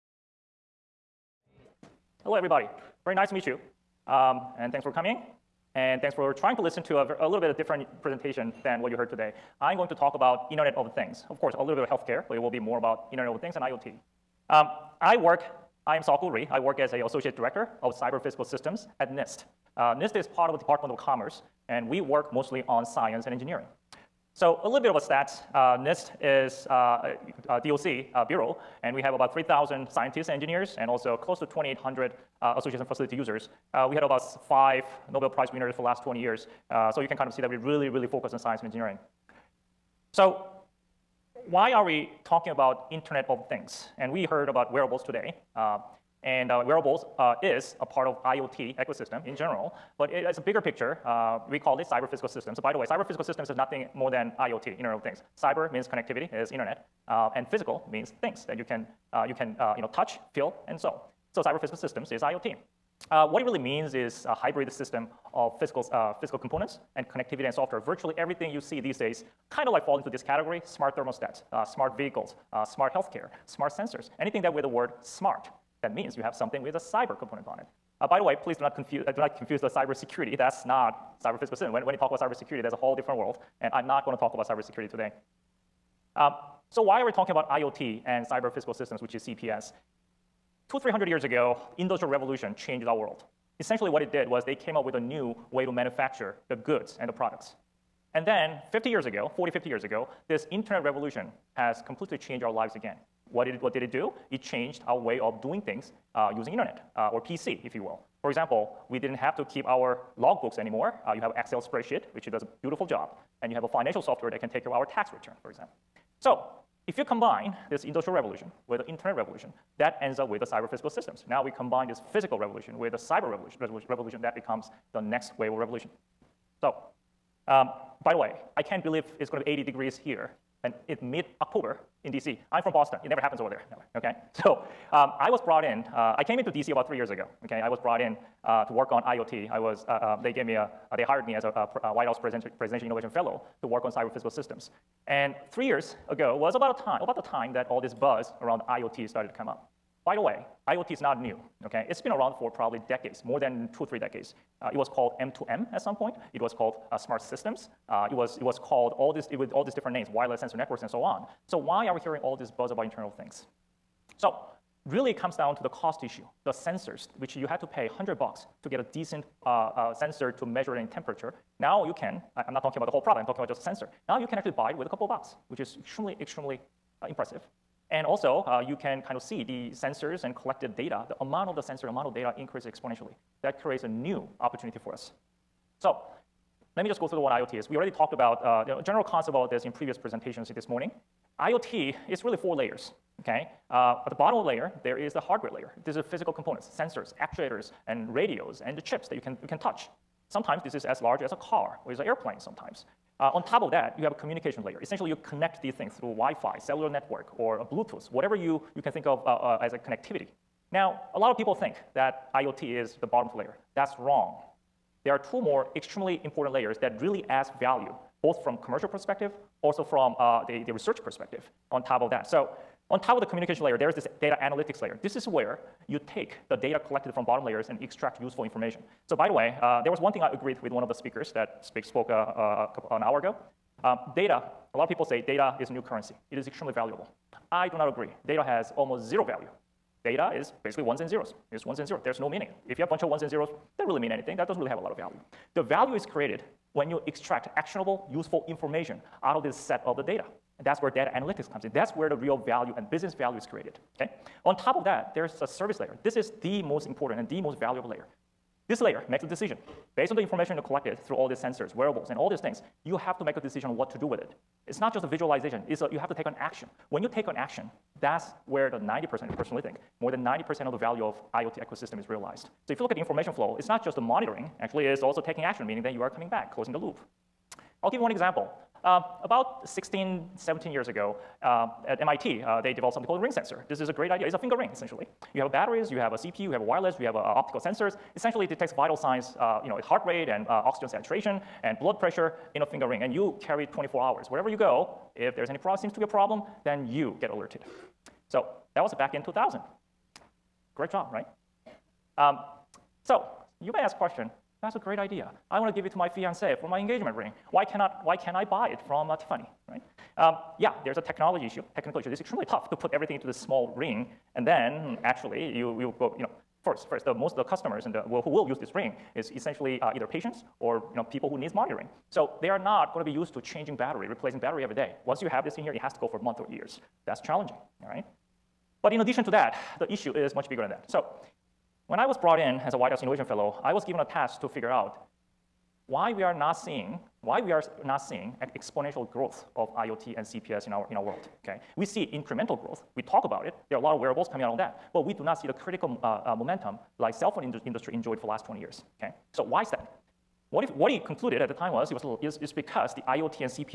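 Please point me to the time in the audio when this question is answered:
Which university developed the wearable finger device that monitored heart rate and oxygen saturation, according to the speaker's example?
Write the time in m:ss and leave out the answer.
4:42.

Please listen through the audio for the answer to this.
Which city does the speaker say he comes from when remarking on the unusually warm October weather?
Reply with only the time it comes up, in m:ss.
2:12.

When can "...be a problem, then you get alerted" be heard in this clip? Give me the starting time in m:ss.
4:55.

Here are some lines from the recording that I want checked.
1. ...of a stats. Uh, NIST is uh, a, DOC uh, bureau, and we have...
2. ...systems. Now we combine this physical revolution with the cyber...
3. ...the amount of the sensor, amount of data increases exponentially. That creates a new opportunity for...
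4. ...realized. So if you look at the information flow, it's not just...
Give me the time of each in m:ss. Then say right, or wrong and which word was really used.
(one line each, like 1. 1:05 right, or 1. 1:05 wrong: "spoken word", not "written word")
1. 0:24 right
2. 2:00 right
3. 3:01 right
4. 4:32 right.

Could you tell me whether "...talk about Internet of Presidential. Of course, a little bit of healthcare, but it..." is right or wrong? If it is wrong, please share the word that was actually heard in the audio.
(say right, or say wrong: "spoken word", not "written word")
wrong: "Things", not "Presidential".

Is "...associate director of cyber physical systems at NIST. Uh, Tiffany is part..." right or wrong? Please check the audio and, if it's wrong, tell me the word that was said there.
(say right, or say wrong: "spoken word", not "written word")
wrong: "NIST", not "Tiffany".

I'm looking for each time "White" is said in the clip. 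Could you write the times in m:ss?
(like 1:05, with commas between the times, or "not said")
2:21, 5:32.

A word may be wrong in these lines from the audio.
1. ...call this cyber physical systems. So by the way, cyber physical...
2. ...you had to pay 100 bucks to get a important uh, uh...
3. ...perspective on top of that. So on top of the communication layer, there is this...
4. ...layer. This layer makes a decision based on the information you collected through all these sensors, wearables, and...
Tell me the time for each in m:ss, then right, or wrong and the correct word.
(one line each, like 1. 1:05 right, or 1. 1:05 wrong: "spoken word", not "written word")
1. 0:51 right
2. 2:47 wrong: "decent", not "important"
3. 3:41 right
4. 4:17 right.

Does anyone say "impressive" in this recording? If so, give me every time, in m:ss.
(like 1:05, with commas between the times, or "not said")
2:57.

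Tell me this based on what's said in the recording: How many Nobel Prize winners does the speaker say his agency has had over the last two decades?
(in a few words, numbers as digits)
5.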